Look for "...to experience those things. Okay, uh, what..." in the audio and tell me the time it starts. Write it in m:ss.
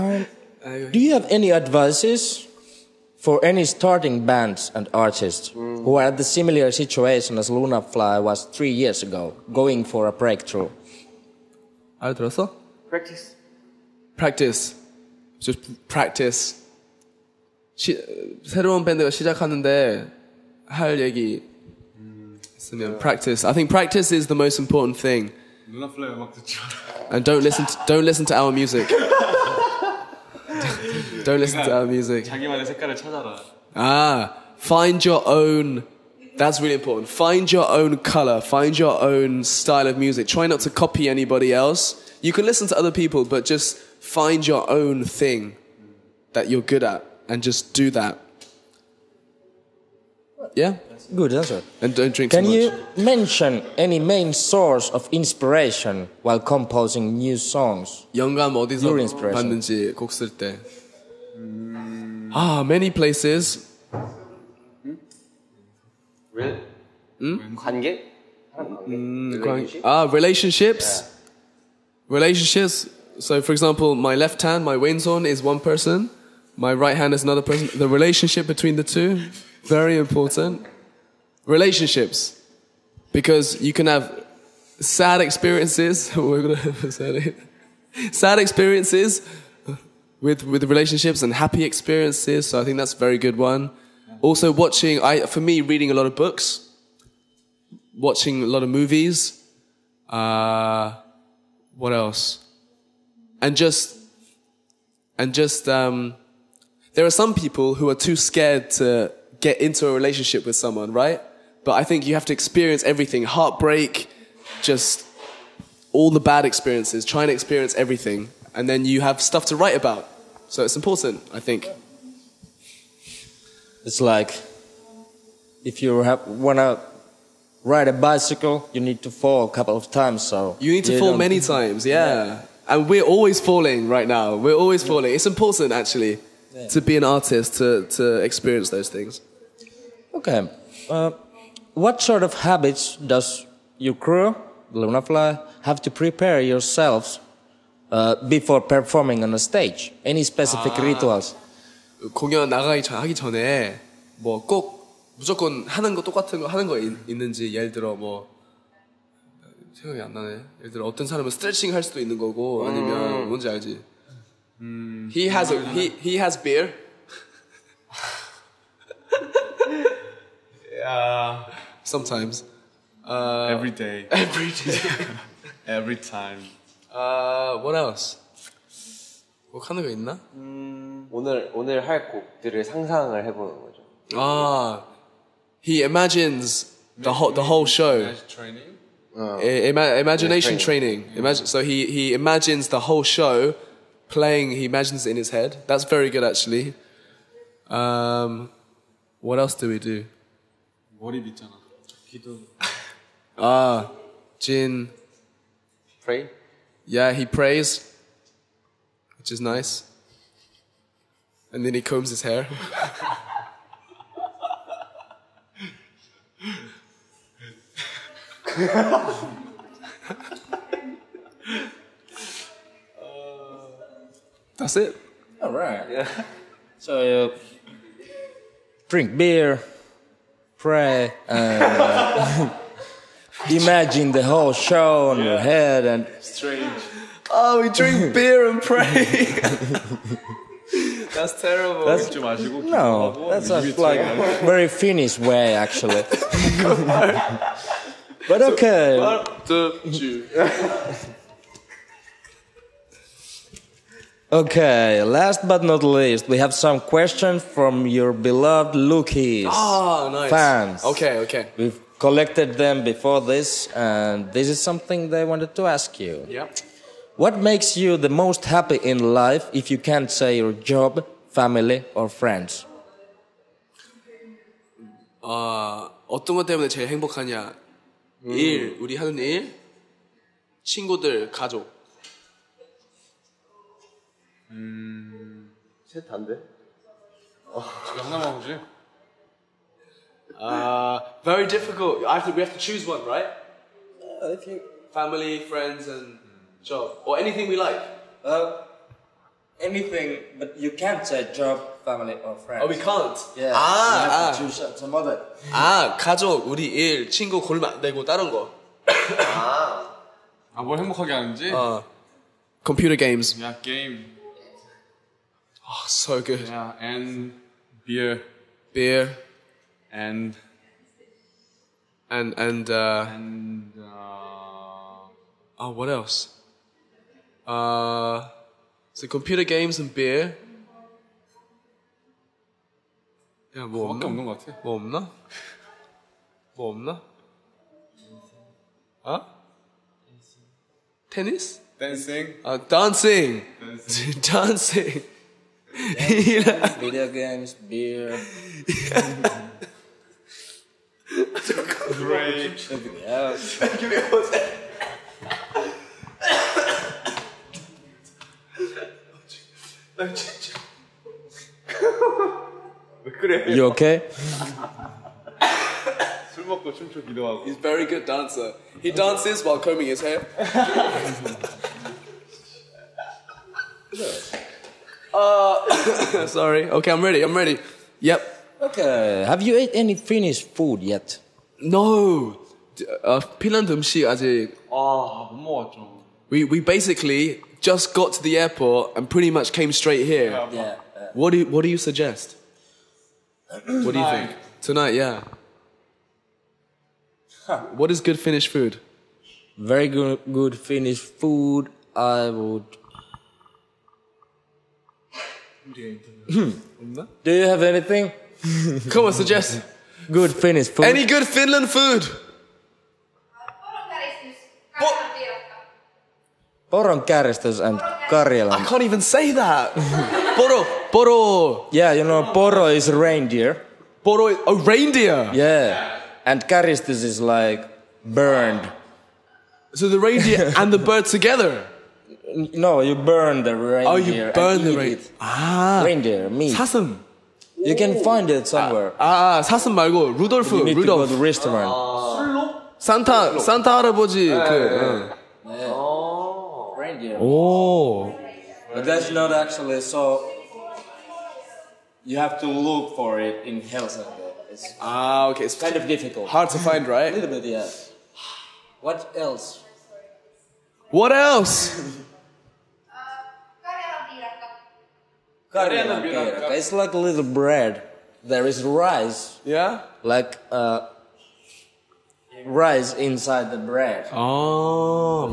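2:17.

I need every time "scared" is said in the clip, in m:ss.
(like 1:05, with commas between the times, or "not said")
1:48.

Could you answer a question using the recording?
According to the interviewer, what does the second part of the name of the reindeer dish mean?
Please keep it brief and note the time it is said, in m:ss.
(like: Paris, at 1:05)
burned, at 7:08.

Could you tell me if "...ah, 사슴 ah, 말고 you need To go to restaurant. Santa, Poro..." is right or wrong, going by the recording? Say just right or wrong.
wrong.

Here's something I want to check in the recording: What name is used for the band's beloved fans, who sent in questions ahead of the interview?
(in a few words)
Lukis.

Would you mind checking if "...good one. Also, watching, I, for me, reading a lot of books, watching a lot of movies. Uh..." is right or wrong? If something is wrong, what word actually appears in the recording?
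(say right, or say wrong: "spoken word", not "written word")
right.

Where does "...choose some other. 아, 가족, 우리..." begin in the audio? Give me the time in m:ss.
5:04.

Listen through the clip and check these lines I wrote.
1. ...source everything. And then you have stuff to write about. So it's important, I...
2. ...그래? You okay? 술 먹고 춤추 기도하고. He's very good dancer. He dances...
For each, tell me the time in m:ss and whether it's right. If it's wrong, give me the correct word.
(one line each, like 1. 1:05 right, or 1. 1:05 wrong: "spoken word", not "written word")
1. 1:57 wrong: "experience", not "source"
2. 6:03 right.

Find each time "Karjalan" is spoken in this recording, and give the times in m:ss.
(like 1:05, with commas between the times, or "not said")
6:58, 7:45.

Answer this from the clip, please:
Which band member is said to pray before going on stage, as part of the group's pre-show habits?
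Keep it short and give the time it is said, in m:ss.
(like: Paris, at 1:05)
Jin, at 3:24.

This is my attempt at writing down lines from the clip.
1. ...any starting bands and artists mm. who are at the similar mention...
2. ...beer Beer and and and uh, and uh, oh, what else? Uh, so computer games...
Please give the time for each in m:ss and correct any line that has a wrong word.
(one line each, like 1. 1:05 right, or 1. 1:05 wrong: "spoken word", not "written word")
1. 0:03 wrong: "situation", not "mention"
2. 5:17 right.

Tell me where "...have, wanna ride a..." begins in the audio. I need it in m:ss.
2:06.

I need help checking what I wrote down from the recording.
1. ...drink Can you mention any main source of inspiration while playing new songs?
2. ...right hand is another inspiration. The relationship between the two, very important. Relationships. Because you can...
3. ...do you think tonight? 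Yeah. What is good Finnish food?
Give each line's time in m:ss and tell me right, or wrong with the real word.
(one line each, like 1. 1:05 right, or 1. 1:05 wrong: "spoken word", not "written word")
1. 0:52 wrong: "composing", not "playing"
2. 1:16 wrong: "person", not "inspiration"
3. 6:33 right.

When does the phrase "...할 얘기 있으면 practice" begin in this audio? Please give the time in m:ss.
0:20.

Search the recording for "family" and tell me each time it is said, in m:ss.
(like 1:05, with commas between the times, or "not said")
4:31, 4:54, 5:01.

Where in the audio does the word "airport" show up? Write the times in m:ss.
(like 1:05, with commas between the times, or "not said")
6:28.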